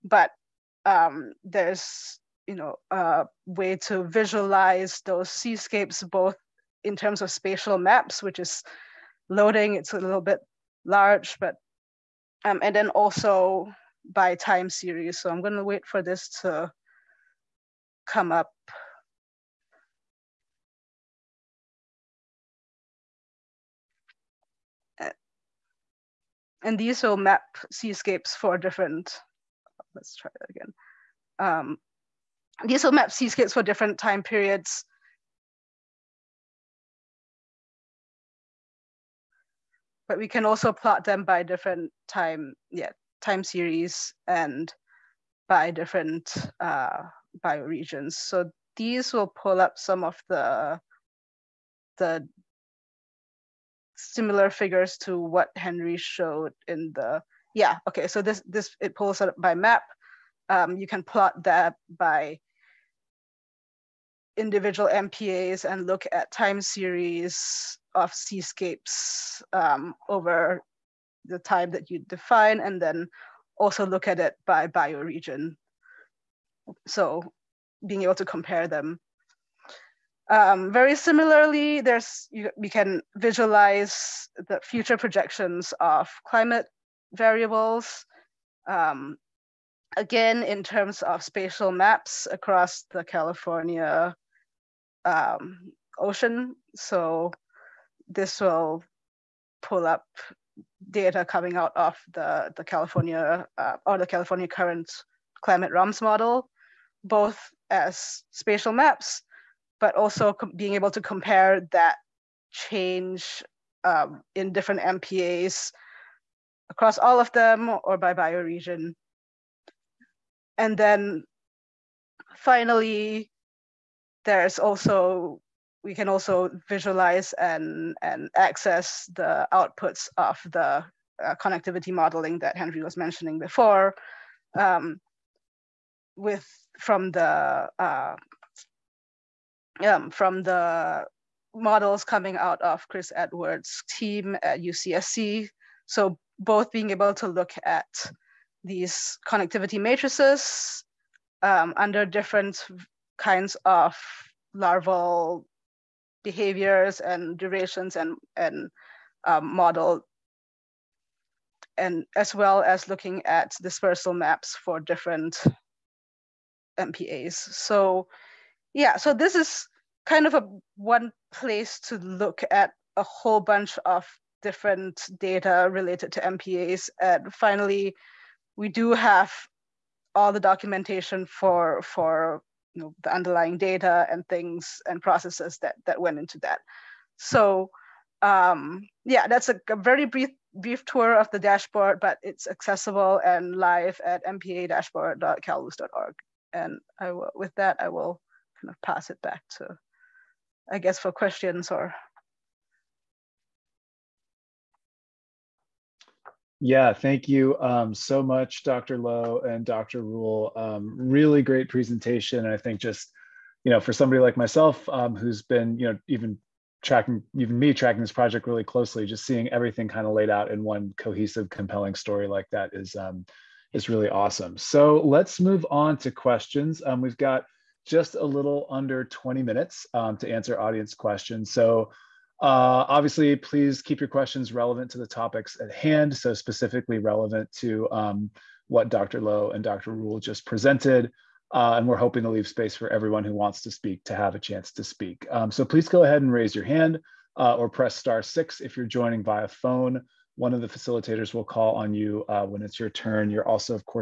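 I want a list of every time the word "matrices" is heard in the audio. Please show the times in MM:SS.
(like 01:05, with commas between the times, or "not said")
02:29.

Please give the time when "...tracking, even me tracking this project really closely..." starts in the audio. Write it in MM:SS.
03:36.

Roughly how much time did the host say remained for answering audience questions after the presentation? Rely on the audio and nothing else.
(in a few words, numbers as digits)
under 20 minutes.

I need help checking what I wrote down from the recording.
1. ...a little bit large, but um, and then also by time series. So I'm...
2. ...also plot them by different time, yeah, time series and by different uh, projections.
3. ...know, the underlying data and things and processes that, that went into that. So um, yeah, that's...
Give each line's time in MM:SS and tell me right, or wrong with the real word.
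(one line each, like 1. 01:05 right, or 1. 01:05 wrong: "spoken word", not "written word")
1. 00:09 right
2. 00:40 wrong: "bioregions", not "projections"
3. 03:02 right.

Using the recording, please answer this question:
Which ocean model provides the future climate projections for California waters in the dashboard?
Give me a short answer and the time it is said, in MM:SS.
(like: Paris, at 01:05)
California current climate ROMS model, at 01:44.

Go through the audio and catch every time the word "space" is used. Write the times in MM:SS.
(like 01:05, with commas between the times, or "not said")
04:02.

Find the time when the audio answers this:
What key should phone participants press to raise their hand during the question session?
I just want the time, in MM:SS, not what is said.
04:07.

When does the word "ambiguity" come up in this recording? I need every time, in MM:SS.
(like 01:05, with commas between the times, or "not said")
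not said.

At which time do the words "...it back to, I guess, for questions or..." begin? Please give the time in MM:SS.
03:19.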